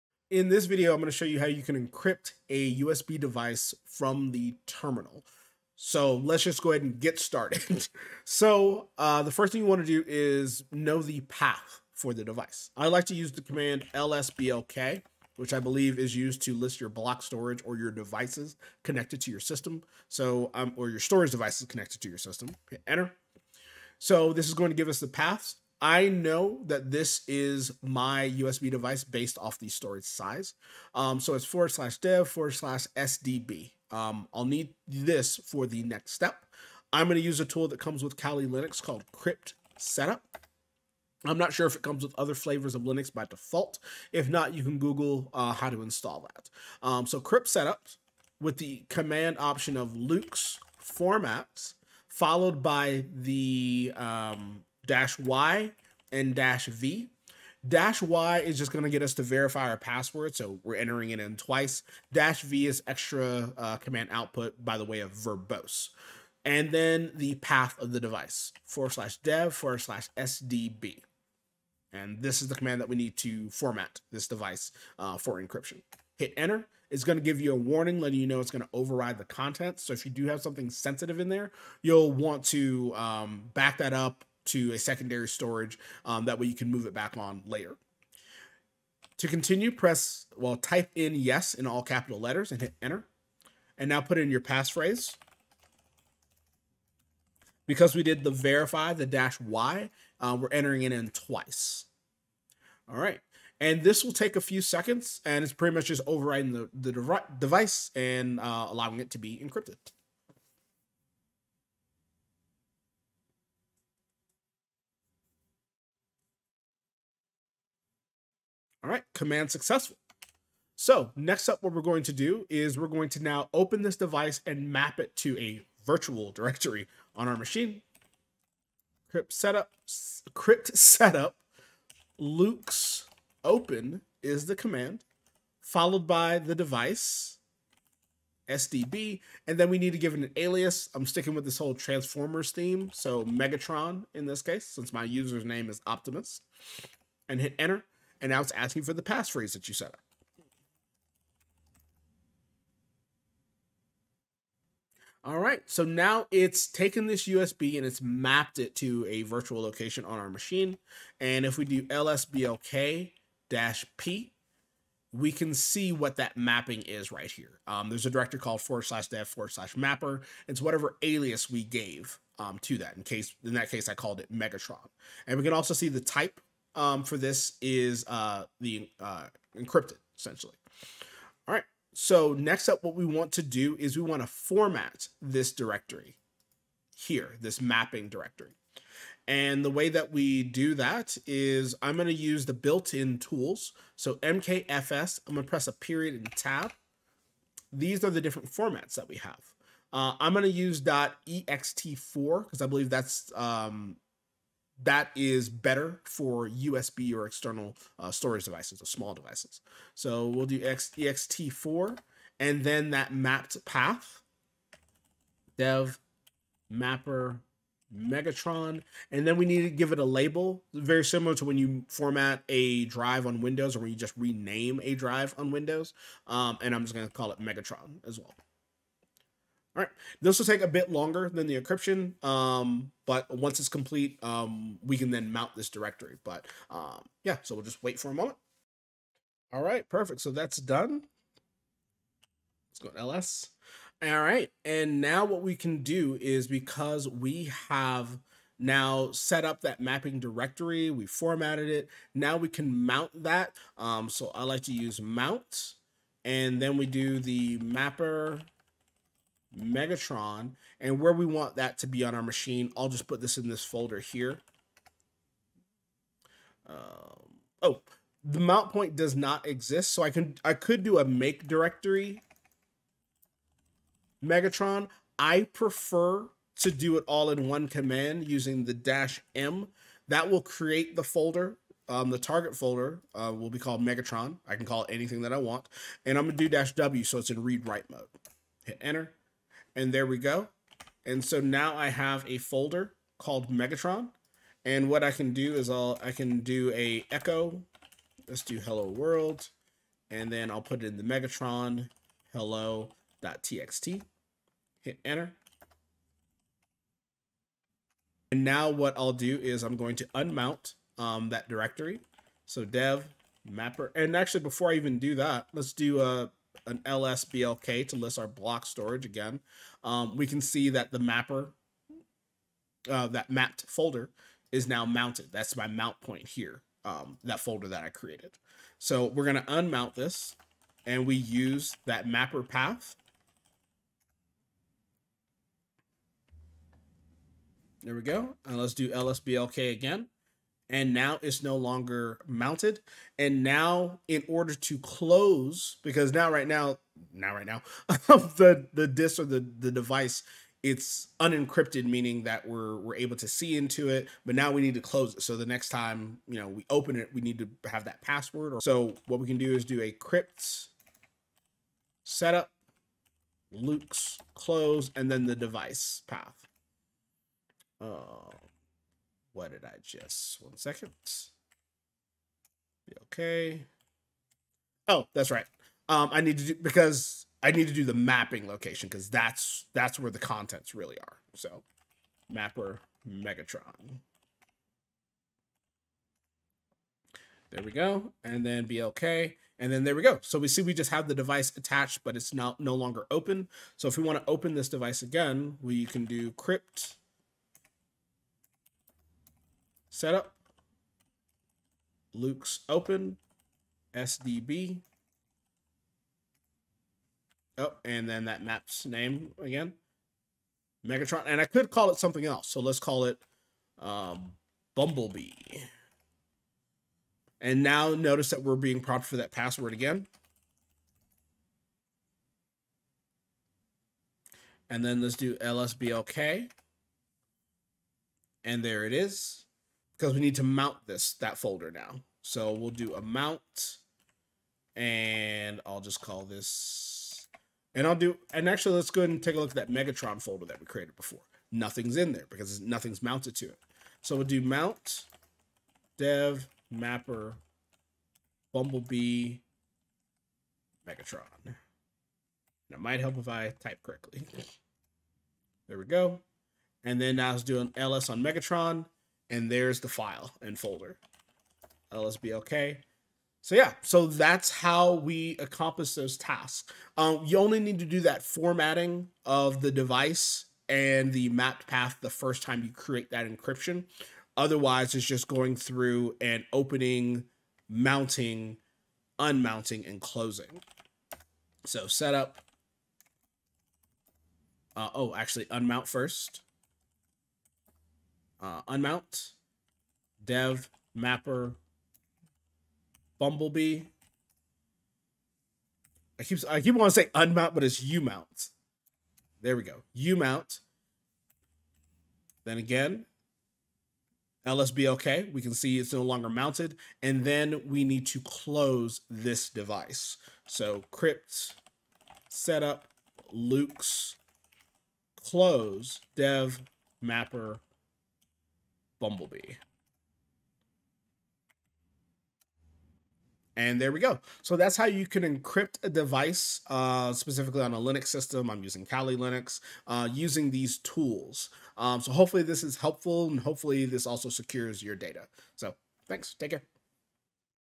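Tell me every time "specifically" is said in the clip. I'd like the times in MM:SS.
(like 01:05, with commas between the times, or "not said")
08:47.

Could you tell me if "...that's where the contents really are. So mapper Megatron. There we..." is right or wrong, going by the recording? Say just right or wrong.
right.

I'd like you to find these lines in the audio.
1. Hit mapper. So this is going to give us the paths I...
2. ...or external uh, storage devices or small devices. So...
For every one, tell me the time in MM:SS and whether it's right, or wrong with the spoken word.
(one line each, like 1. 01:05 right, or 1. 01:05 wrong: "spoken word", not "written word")
1. 00:22 wrong: "enter", not "mapper"
2. 03:27 right.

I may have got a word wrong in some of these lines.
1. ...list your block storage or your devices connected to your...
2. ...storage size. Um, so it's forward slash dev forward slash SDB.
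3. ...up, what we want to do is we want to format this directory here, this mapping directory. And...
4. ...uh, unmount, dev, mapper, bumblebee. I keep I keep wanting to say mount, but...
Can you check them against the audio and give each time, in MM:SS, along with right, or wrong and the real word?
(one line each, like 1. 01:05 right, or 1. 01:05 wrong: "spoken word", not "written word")
1. 00:16 right
2. 00:29 right
3. 03:02 right
4. 08:08 wrong: "unmount", not "mount".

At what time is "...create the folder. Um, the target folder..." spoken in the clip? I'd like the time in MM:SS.
04:40.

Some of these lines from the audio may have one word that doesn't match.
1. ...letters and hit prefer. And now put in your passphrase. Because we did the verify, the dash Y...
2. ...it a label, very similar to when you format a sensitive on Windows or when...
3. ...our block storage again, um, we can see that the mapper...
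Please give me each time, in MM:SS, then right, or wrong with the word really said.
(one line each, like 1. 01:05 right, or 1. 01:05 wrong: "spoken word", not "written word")
1. 01:32 wrong: "enter", not "prefer"
2. 03:39 wrong: "drive", not "sensitive"
3. 05:18 right.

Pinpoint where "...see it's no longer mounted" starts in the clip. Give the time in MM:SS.
08:25.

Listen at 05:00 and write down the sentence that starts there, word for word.
And then I'll put it in the Megatron hello.txt.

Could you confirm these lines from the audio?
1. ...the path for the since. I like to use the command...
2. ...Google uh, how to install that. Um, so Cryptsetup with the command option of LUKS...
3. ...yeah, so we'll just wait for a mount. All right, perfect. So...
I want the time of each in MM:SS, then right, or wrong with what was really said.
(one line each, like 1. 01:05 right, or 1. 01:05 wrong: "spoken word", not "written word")
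1. 00:11 wrong: "device", not "since"
2. 00:44 right
3. 03:57 wrong: "moment", not "mount".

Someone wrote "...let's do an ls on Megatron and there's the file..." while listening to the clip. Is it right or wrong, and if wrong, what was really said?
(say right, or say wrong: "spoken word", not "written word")
right.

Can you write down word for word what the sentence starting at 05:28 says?
So we're going to unmount this and we use that mapper path.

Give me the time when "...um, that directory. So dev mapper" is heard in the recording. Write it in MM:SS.
05:10.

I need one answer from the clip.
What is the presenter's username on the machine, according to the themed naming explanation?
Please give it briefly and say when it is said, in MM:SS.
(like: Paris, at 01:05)
Optimus, at 02:25.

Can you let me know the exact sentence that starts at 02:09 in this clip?
Cryptsetup, crypt setup, LUKS open is the command, followed by the device, SDB, and then we need to give it an alias.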